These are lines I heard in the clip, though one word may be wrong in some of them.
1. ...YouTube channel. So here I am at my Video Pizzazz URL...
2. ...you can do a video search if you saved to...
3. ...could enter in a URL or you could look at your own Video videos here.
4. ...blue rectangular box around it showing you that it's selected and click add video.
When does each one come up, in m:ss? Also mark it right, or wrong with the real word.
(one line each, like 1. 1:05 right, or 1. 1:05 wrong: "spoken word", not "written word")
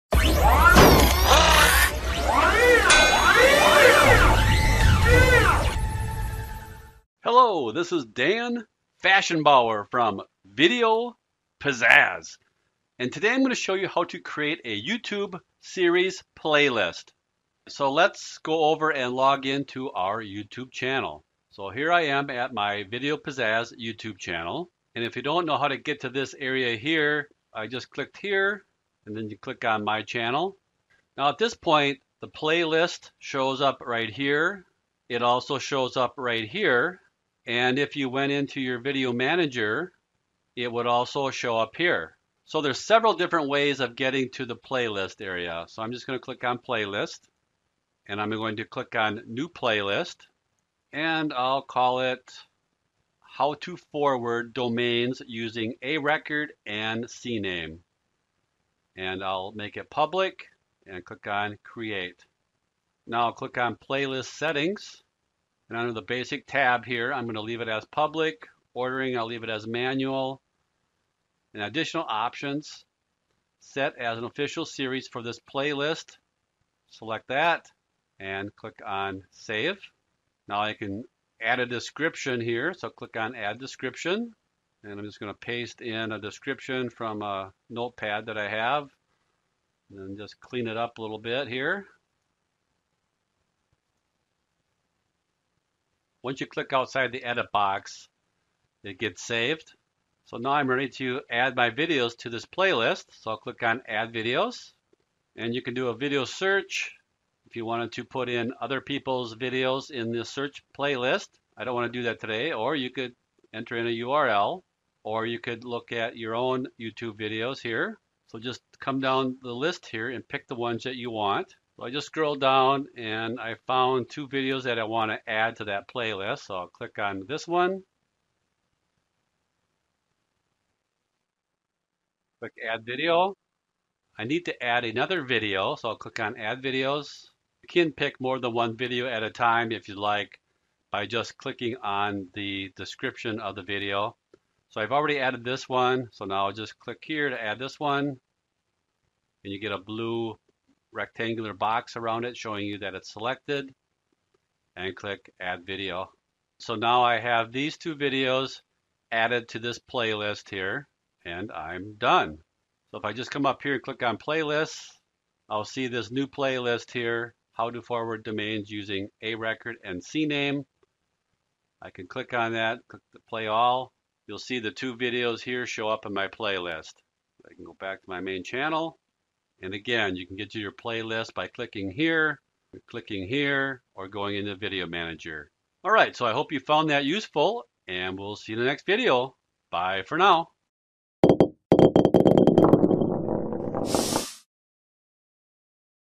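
1. 0:20 wrong: "YouTube", not "URL"
2. 1:45 wrong: "wanted", not "saved"
3. 1:52 wrong: "YouTube", not "Video"
4. 2:29 right.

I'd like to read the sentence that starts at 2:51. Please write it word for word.
I can click on that, click the play all.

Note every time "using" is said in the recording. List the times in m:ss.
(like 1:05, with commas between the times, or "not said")
0:55, 2:48.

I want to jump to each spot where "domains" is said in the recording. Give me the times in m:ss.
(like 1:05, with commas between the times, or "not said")
0:54, 2:48.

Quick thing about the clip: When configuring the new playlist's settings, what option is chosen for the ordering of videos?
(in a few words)
Manual.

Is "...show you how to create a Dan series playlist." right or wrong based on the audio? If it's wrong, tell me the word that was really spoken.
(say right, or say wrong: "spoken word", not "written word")
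wrong: "YouTube", not "Dan".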